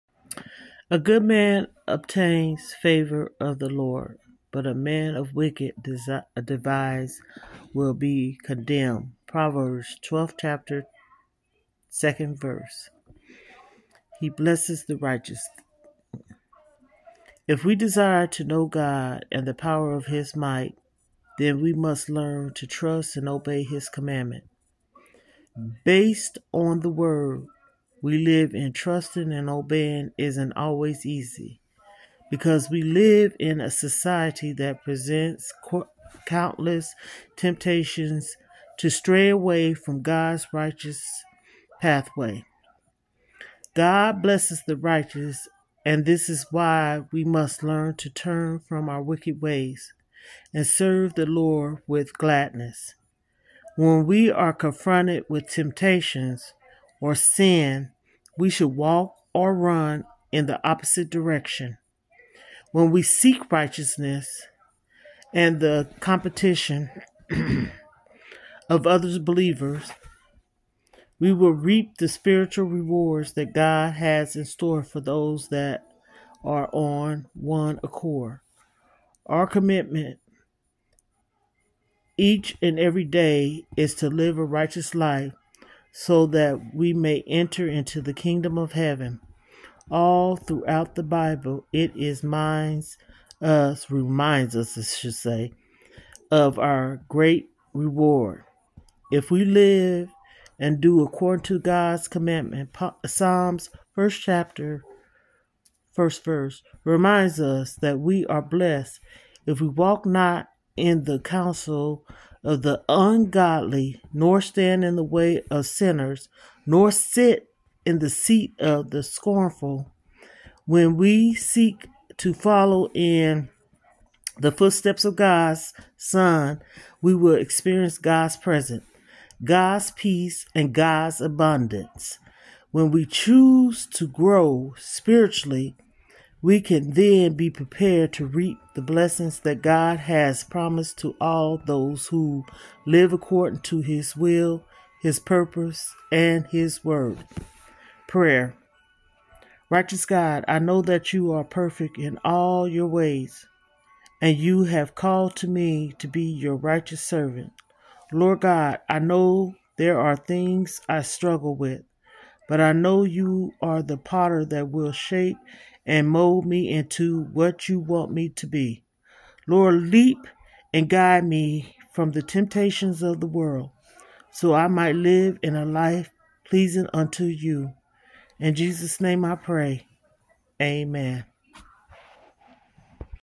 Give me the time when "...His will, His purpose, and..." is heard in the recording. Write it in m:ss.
2:23.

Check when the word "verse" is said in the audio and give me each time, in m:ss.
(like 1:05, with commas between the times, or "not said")
0:12, 1:46.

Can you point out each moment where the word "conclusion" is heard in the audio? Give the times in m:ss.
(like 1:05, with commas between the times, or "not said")
not said.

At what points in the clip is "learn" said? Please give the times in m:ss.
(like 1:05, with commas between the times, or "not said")
0:22, 0:47.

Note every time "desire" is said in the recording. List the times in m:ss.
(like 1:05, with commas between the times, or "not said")
0:17.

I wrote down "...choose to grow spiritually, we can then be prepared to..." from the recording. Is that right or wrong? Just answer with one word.
right.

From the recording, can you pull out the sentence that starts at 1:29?
All throughout the Bible, it is minds us reminds us, I should say, of our great reward.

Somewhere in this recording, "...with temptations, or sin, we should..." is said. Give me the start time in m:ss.
0:55.